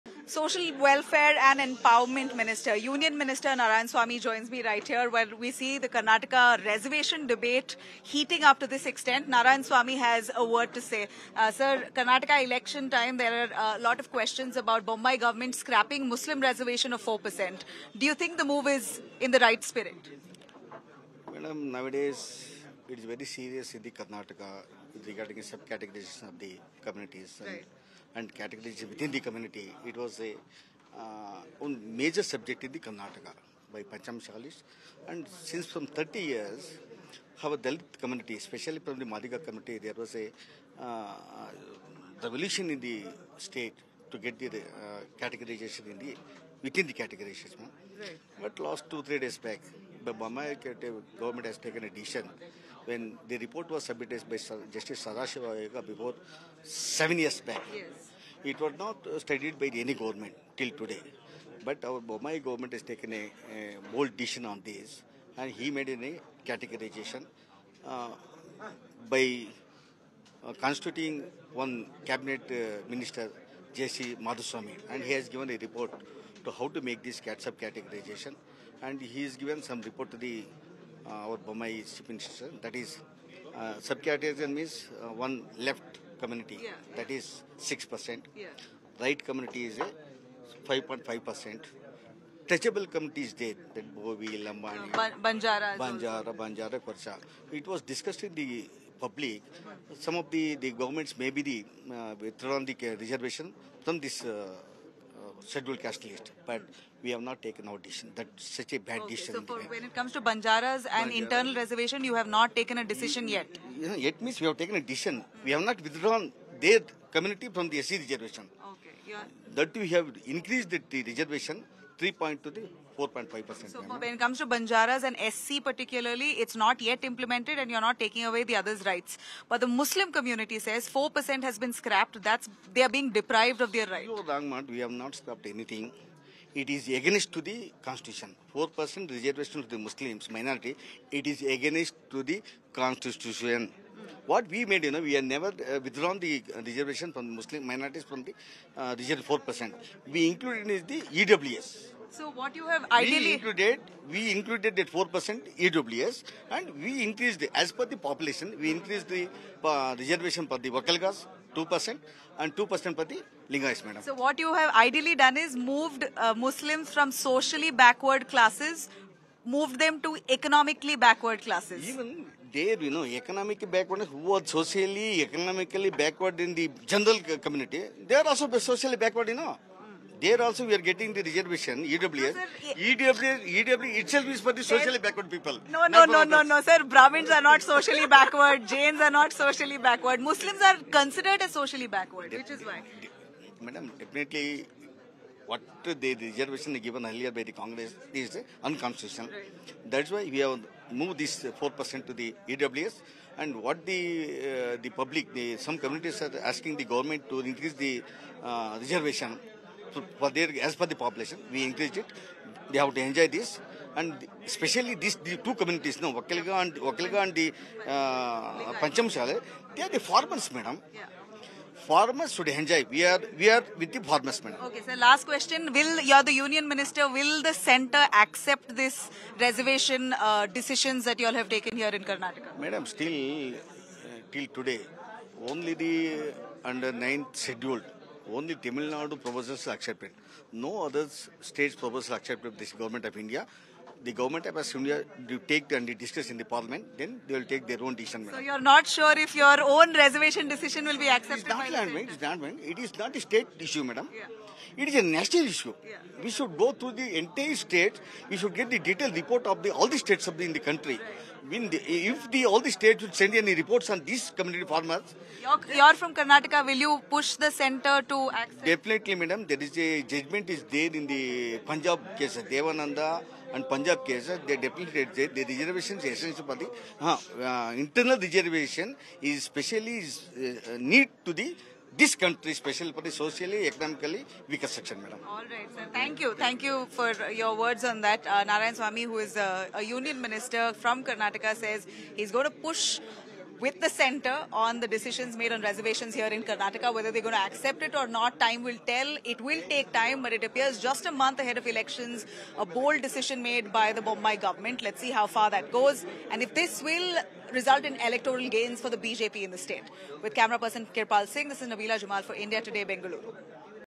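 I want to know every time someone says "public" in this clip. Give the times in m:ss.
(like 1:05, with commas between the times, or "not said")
1:38, 3:24.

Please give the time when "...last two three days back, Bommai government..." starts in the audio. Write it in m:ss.
0:48.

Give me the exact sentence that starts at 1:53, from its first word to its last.
You know, yet means we have taken a decision.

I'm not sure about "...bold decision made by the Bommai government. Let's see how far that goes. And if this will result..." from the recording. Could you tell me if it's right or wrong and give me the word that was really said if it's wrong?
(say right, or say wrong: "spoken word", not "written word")
right.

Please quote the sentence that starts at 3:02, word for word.
No, EWS, itself is for the socially backward people.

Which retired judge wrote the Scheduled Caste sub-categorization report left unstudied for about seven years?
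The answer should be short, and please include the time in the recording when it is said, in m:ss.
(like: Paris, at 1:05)
Justice Sadashiva, at 0:54.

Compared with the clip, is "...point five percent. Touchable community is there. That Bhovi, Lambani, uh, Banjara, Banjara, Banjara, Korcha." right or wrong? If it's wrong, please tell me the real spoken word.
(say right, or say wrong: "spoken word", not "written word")
right.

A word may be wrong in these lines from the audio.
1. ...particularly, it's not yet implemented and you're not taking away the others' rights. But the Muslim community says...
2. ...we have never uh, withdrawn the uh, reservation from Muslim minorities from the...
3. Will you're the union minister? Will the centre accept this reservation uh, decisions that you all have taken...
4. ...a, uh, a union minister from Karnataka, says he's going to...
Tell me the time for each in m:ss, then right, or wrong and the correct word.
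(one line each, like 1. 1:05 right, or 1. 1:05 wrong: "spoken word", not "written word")
1. 2:05 right
2. 2:25 right
3. 3:45 right
4. 4:49 right.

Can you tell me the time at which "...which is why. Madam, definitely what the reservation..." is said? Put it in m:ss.
3:12.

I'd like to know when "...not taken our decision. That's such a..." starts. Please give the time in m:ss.
1:47.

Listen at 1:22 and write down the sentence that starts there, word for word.
That is, uh, categorization means uh, one left community.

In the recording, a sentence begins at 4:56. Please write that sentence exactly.
Whether they're going to accept it or not, time will tell.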